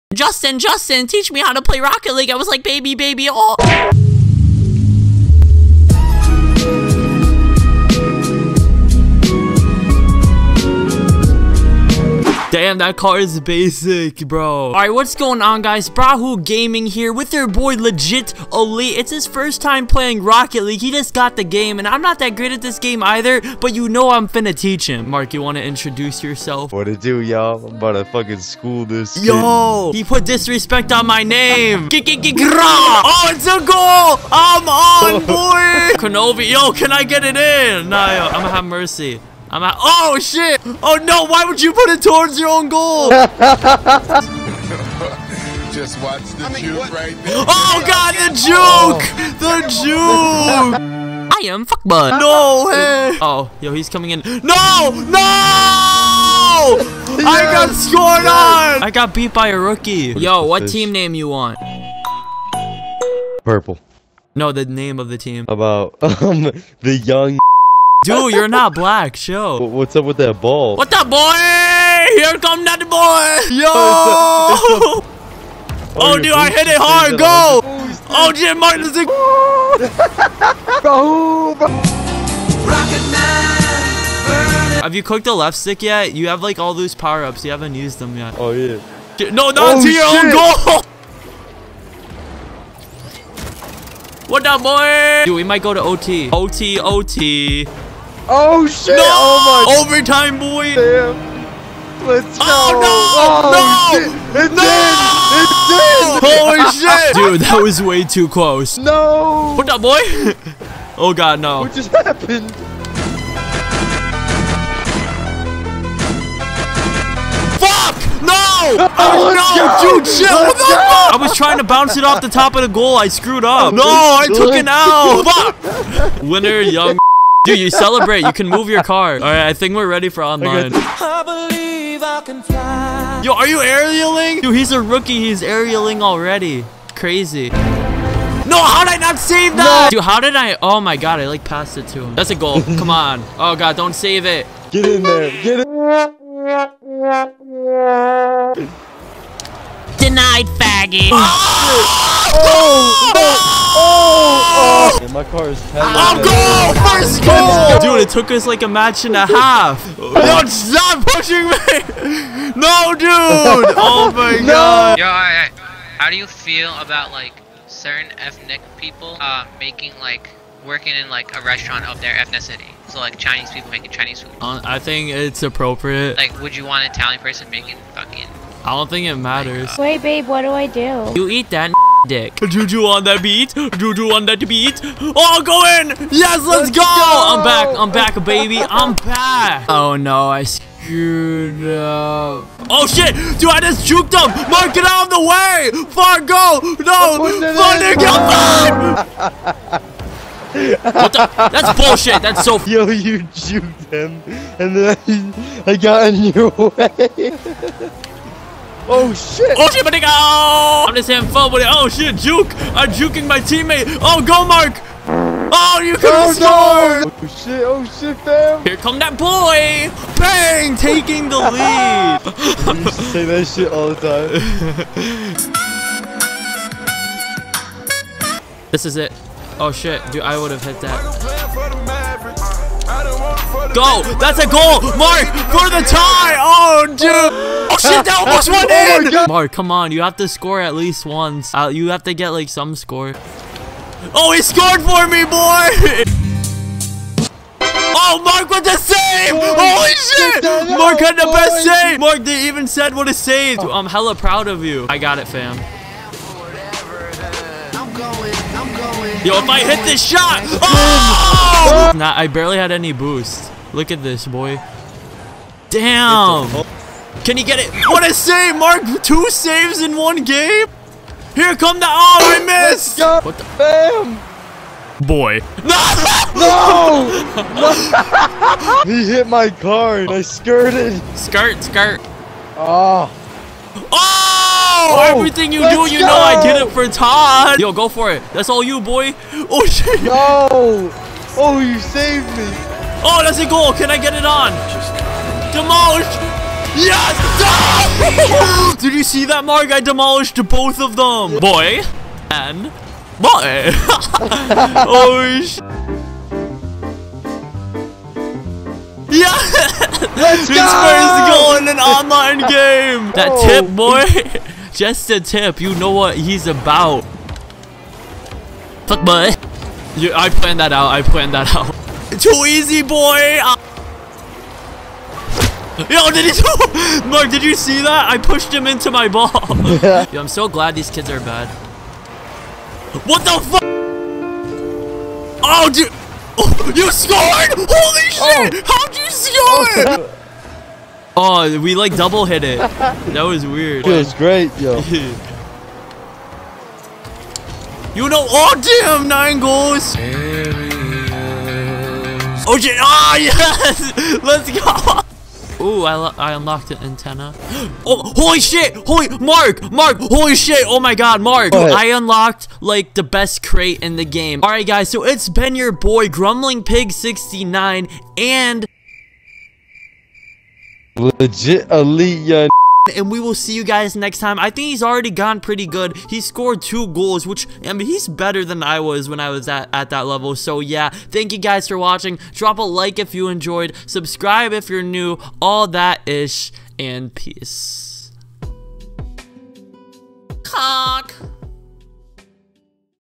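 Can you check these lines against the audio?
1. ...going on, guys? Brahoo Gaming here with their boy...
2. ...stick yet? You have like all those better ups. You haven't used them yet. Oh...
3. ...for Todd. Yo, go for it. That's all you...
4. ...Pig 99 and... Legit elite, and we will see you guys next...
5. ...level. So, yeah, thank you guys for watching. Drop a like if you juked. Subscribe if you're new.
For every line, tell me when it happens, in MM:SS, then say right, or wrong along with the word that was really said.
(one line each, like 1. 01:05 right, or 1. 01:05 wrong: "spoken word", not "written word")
1. 00:15 right
2. 01:25 wrong: "power", not "better"
3. 04:46 right
4. 06:06 wrong: "69", not "99"
5. 06:20 wrong: "enjoyed", not "juked".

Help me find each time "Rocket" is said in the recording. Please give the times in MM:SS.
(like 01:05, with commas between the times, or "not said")
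00:01, 00:20.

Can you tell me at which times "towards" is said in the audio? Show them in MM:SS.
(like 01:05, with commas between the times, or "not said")
00:42.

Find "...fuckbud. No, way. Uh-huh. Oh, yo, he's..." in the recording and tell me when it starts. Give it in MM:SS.
00:51.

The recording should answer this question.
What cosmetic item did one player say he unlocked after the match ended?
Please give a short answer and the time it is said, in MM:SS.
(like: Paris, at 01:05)
An antenna, at 05:56.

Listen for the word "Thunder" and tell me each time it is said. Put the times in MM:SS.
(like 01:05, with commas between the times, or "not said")
03:17.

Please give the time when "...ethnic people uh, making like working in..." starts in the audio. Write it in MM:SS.
02:48.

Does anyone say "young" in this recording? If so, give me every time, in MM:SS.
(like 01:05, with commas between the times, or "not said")
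01:07, 02:06.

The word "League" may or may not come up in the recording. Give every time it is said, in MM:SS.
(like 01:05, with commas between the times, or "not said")
00:02, 00:20.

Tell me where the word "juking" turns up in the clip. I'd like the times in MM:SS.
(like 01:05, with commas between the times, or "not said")
03:32.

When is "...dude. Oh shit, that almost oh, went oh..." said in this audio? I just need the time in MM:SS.
03:56.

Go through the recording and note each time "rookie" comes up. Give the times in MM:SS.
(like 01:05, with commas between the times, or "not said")
00:59, 02:14.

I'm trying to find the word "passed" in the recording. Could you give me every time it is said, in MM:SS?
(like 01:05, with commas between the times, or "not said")
02:21.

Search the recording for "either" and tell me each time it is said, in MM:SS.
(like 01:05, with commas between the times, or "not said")
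00:23.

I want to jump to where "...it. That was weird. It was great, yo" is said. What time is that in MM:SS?
05:42.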